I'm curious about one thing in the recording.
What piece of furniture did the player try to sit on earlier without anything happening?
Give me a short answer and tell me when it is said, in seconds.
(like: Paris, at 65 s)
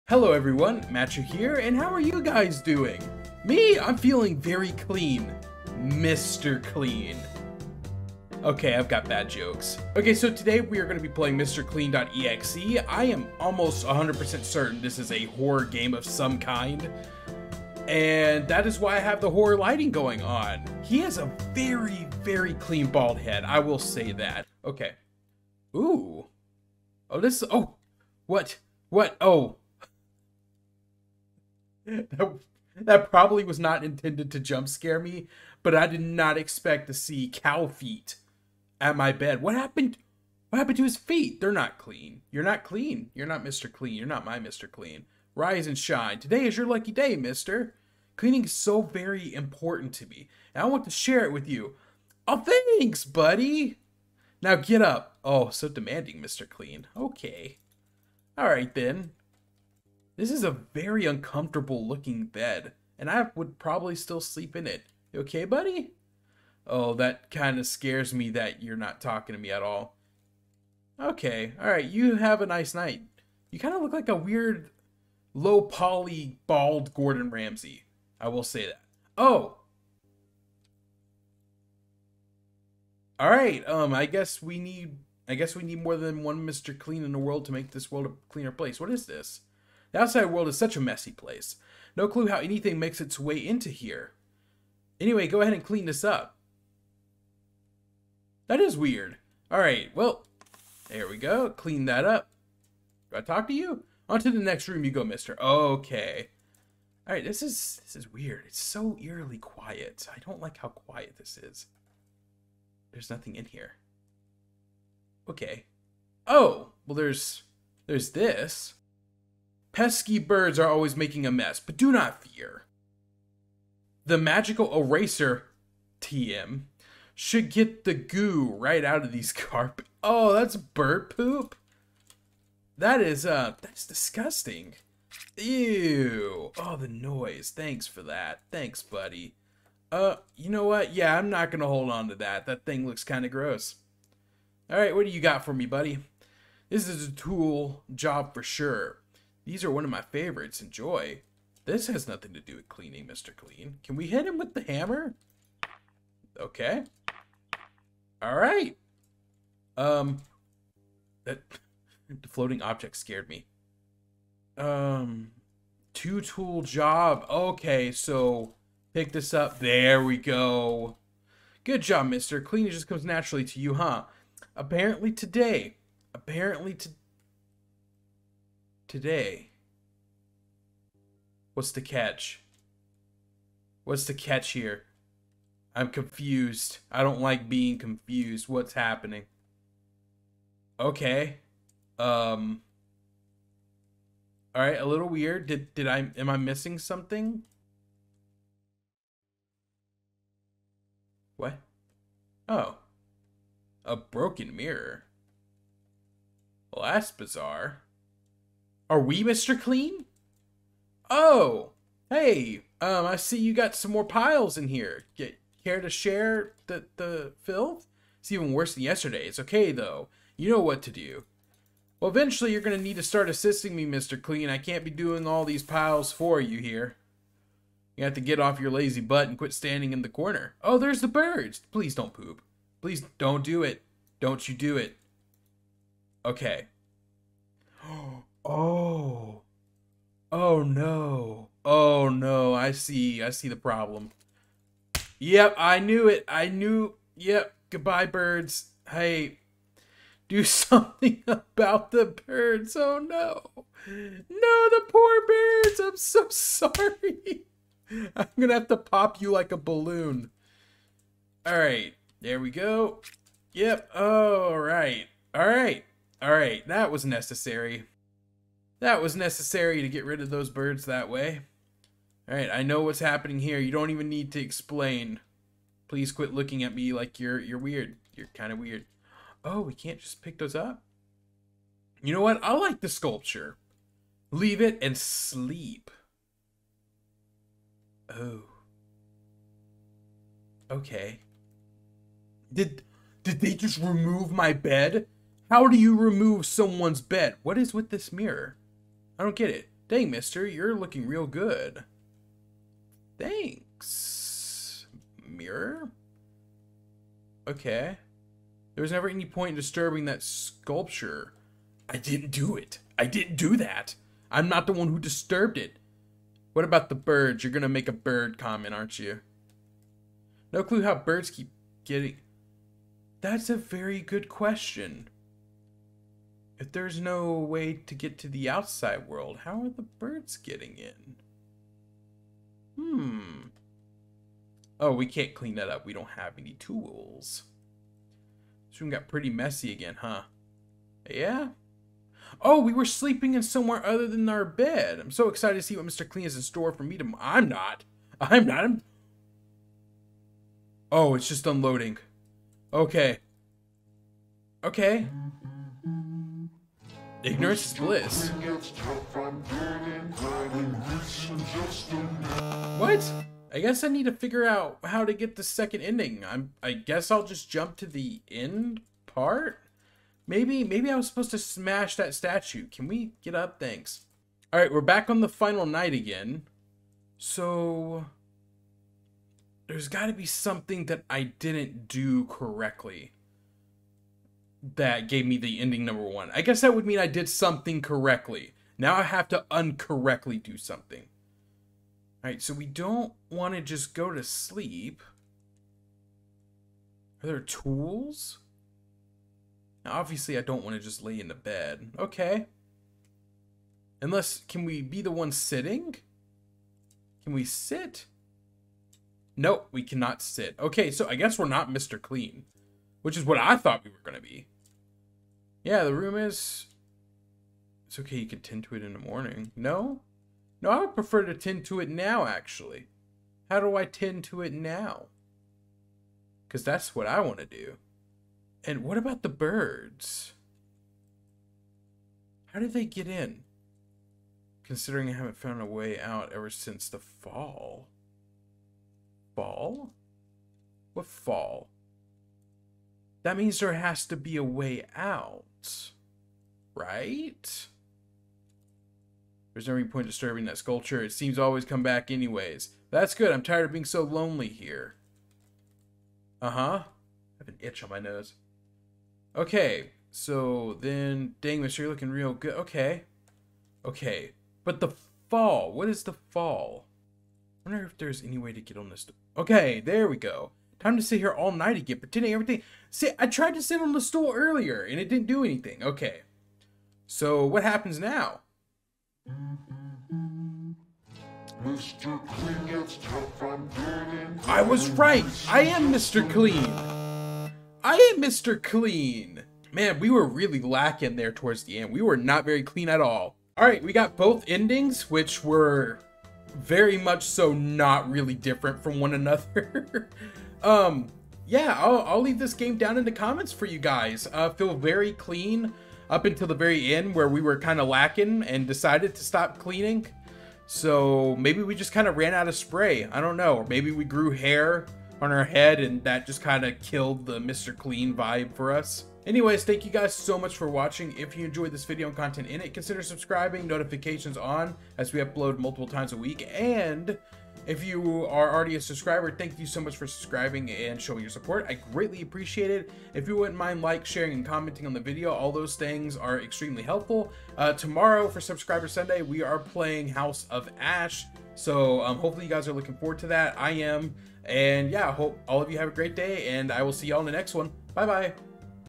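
The stool, at 474 s.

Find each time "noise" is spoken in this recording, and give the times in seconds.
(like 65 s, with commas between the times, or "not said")
136 s.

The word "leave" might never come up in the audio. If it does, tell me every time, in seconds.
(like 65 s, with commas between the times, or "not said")
284 s, 502 s.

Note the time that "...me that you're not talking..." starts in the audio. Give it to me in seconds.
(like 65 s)
68 s.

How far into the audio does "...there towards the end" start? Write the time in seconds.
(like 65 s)
491 s.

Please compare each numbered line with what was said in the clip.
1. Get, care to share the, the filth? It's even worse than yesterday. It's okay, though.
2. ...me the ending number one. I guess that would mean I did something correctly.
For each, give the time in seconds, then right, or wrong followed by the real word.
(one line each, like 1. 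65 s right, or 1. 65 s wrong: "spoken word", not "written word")
1. 215 s right
2. 385 s right.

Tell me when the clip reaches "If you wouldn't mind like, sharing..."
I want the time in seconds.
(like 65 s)
533 s.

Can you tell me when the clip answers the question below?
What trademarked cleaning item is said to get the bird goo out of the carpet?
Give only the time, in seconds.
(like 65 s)
124 s.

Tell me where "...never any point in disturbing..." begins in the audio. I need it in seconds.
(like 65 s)
308 s.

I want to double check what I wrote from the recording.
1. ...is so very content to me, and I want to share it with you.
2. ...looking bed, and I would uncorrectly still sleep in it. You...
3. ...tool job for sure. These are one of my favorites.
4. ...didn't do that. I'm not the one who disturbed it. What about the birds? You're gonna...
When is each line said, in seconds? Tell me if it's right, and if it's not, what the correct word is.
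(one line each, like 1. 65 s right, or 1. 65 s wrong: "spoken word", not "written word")
1. 48 s wrong: "important", not "content"
2. 61 s wrong: "probably", not "uncorrectly"
3. 147 s right
4. 313 s right.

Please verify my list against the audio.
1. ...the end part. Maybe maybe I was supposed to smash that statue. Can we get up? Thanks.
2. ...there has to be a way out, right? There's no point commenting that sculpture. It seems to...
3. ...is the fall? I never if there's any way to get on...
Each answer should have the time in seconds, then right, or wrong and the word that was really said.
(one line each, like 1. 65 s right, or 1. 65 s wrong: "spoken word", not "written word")
1. 367 s right
2. 443 s wrong: "disturbing", not "commenting"
3. 465 s wrong: "wonder", not "never".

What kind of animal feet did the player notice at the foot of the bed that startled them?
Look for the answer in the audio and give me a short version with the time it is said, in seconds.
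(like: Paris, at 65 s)
Cow feet, at 37 s.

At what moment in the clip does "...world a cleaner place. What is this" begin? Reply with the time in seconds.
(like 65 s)
87 s.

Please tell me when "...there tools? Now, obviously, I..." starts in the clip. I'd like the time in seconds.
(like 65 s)
397 s.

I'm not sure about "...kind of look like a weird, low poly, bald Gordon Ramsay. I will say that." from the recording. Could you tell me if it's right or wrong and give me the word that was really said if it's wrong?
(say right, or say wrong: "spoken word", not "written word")
right.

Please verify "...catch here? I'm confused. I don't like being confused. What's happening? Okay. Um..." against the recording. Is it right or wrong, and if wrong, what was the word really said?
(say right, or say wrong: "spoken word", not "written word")
right.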